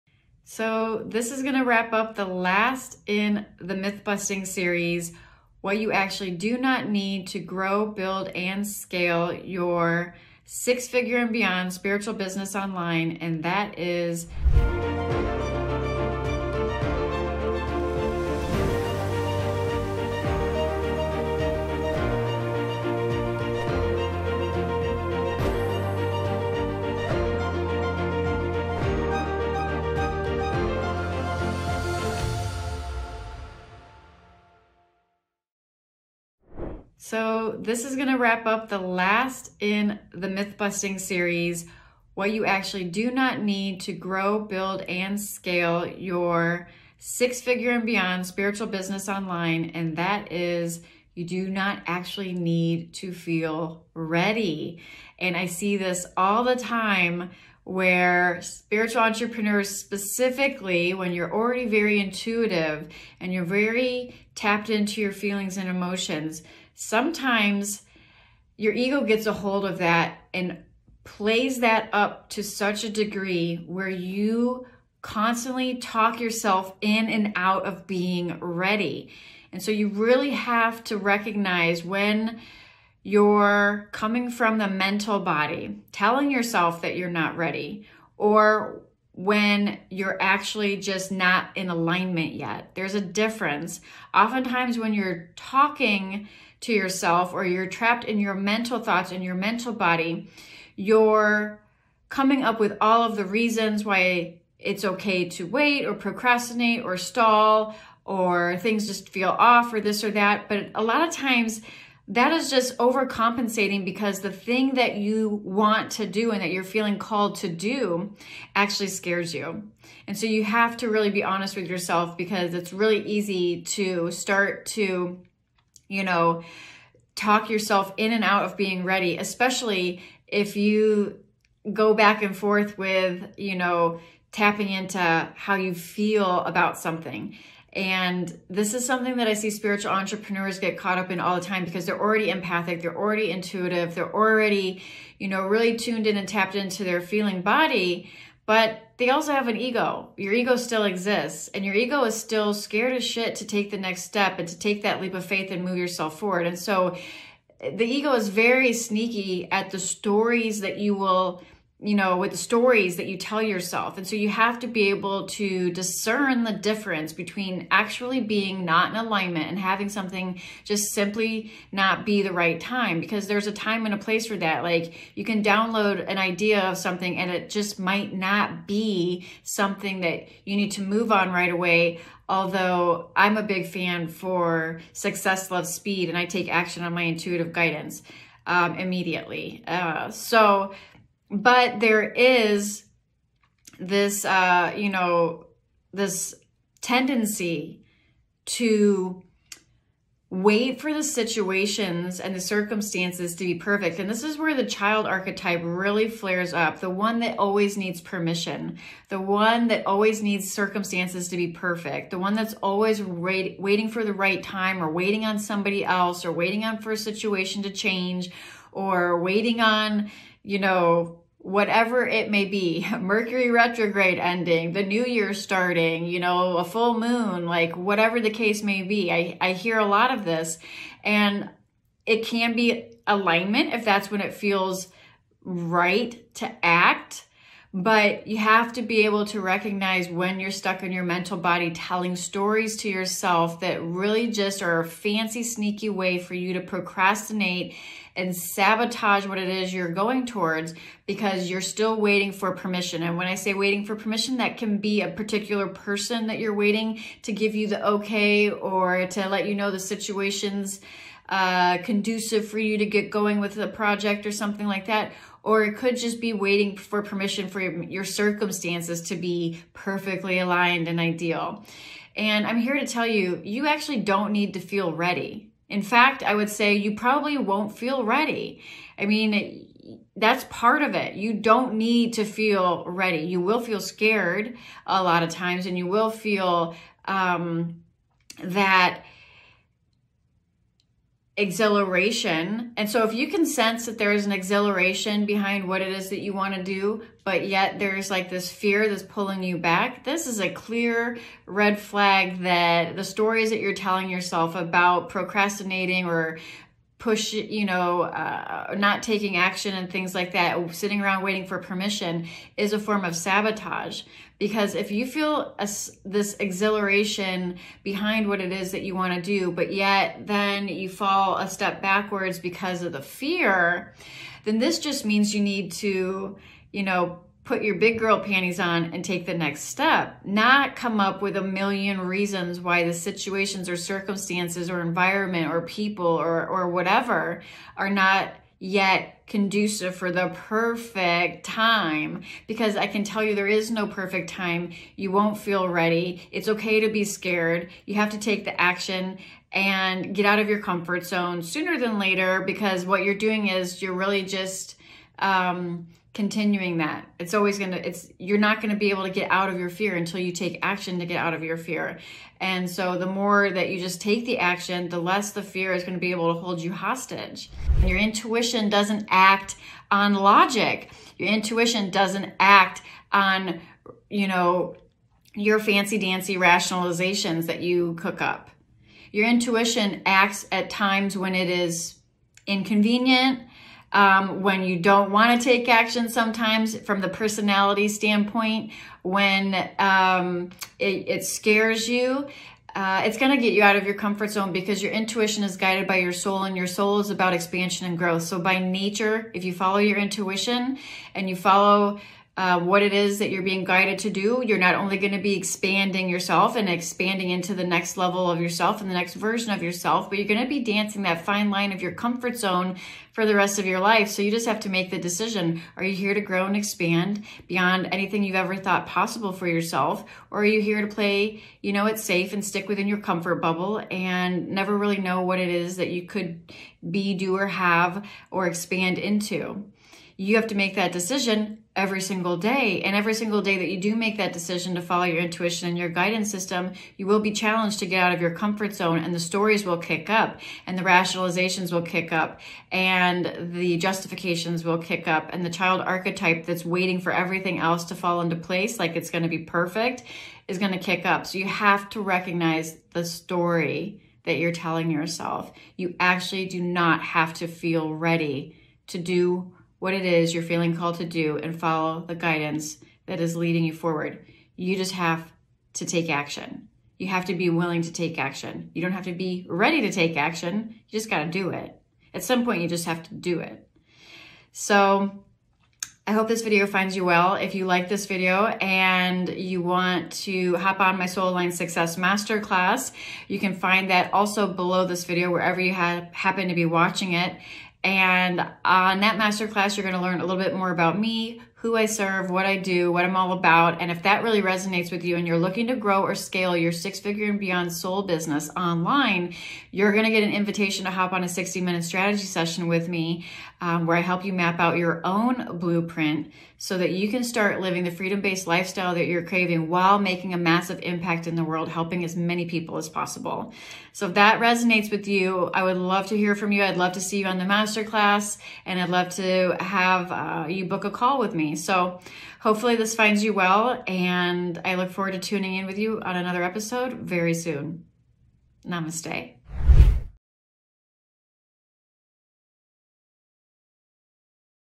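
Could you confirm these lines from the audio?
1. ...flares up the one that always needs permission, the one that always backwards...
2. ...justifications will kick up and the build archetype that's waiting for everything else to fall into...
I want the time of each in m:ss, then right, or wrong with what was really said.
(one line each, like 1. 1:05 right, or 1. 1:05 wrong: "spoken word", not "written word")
1. 3:26 wrong: "needs", not "backwards"
2. 7:23 wrong: "child", not "build".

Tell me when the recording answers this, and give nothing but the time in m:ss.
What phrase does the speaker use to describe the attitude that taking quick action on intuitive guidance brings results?
3:04.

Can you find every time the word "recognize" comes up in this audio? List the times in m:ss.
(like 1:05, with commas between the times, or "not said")
1:20, 3:59, 7:32.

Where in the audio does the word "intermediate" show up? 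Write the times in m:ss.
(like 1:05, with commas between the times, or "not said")
not said.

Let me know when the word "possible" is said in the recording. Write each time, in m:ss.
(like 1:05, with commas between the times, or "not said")
6:58, 8:32.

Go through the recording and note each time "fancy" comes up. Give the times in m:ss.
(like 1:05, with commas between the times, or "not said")
4:04, 6:15.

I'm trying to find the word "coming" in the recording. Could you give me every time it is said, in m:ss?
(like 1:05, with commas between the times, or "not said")
1:23, 1:42.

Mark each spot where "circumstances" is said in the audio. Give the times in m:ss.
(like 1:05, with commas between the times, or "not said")
3:22, 3:30, 4:28, 5:33.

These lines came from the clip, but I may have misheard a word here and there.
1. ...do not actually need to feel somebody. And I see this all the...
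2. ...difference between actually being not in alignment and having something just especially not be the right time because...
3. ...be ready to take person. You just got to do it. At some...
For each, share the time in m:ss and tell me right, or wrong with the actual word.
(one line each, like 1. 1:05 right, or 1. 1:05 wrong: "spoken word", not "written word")
1. 0:51 wrong: "ready", not "somebody"
2. 2:46 wrong: "simply", not "especially"
3. 7:49 wrong: "action", not "person".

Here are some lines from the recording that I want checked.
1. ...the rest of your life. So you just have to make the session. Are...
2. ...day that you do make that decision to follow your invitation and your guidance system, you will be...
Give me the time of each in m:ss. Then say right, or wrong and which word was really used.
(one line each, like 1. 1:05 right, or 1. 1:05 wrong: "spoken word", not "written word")
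1. 6:53 wrong: "decision", not "session"
2. 7:13 wrong: "intuition", not "invitation".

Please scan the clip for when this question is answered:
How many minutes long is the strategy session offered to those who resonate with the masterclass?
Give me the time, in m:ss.
8:21.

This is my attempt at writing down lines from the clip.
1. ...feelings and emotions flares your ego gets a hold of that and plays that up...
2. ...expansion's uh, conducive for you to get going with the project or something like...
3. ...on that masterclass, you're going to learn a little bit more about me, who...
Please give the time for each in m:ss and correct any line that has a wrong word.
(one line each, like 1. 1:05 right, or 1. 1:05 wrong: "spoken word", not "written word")
1. 1:05 wrong: "sometimes", not "flares"
2. 4:19 wrong: "situation", not "expansion"
3. 8:08 right.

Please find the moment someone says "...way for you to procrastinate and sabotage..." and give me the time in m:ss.
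4:05.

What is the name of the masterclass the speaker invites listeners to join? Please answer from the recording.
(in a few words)
Soul Aligned Success Masterclass.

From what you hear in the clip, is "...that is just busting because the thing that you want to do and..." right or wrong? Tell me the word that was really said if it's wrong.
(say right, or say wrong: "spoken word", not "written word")
wrong: "overcompensating", not "busting".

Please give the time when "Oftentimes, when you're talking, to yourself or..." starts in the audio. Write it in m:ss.
1:34.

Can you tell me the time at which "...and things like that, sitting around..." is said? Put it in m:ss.
5:09.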